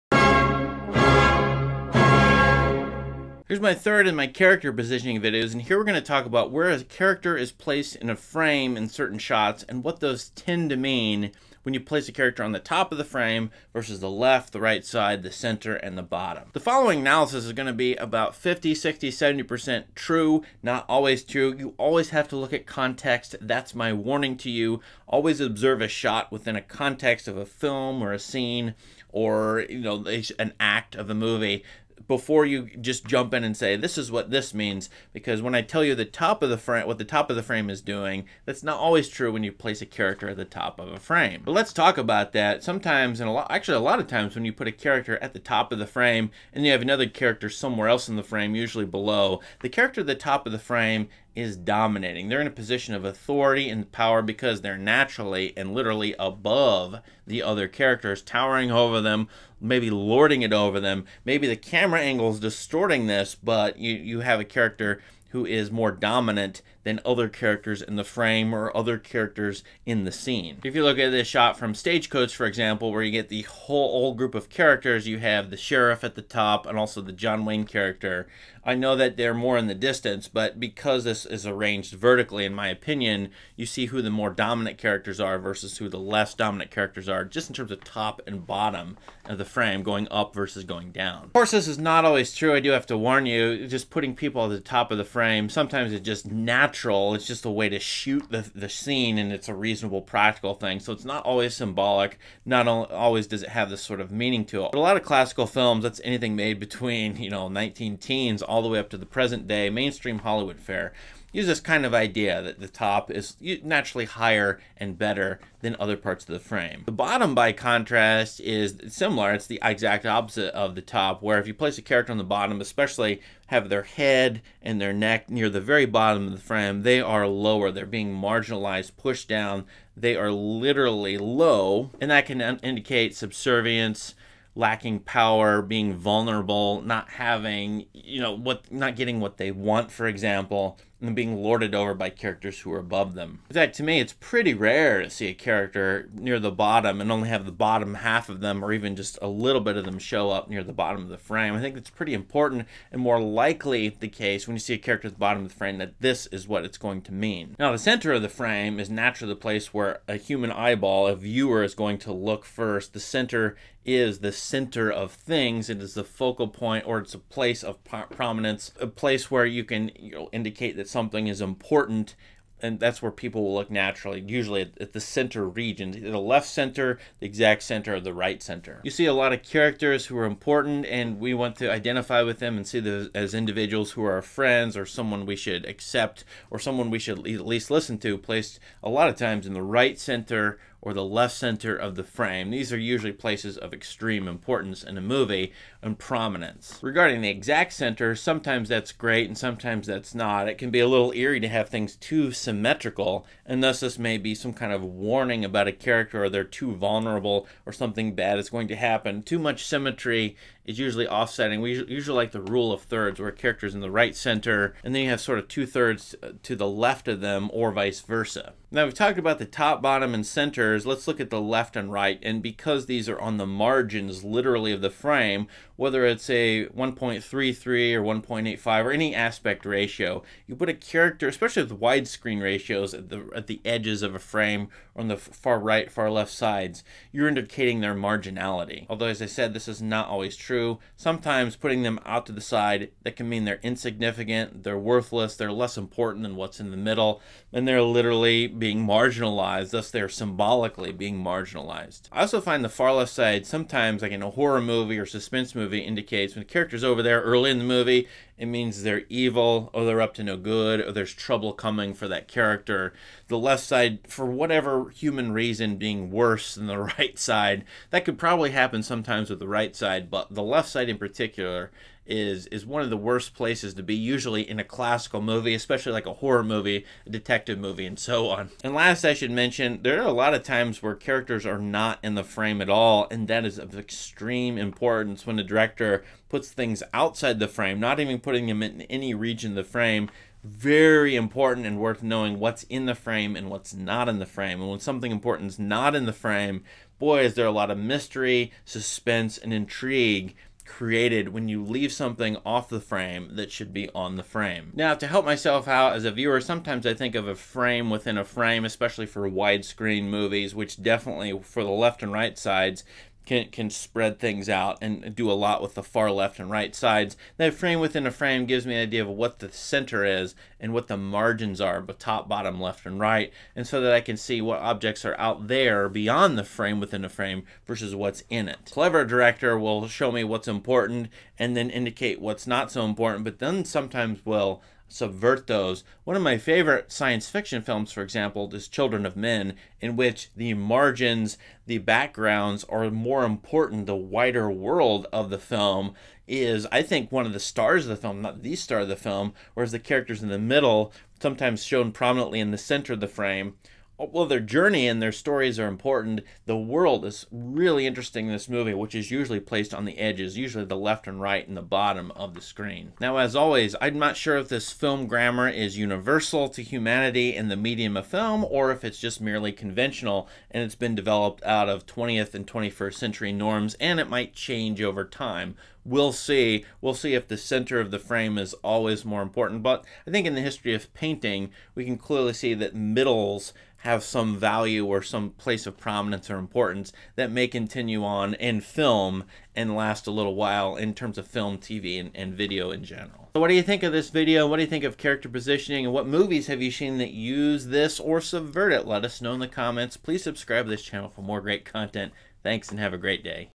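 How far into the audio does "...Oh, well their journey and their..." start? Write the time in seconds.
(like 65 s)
354 s.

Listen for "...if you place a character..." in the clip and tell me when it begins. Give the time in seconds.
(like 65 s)
121 s.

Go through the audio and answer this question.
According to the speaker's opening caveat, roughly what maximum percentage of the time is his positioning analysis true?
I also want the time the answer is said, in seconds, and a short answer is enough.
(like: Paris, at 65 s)
70%, at 19 s.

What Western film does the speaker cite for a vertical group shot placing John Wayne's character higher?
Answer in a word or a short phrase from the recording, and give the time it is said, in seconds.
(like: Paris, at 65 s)
Stagecoach, at 71 s.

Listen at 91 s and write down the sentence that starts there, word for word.
Of course, this is not always true.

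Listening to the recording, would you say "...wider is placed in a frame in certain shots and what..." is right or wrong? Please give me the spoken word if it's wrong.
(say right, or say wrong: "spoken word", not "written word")
wrong: "character", not "wider".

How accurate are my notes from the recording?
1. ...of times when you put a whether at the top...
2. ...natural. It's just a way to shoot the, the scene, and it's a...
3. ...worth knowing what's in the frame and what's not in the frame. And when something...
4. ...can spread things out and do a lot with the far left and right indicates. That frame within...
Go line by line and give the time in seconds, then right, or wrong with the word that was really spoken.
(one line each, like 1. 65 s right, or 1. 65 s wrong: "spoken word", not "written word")
1. 43 s wrong: "character", not "whether"
2. 96 s right
3. 291 s right
4. 313 s wrong: "sides", not "indicates".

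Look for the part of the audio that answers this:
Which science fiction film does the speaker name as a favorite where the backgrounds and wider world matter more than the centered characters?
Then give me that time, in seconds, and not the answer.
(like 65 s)
338 s.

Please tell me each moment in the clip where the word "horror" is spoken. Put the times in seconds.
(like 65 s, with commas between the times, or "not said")
254 s, 276 s.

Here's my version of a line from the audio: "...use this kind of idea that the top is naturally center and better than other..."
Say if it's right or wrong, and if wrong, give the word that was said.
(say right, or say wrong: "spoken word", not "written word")
wrong: "higher", not "center".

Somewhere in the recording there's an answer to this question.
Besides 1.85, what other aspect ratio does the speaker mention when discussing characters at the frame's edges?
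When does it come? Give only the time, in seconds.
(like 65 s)
226 s.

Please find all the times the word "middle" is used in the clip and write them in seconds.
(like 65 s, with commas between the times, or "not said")
246 s, 350 s, 382 s.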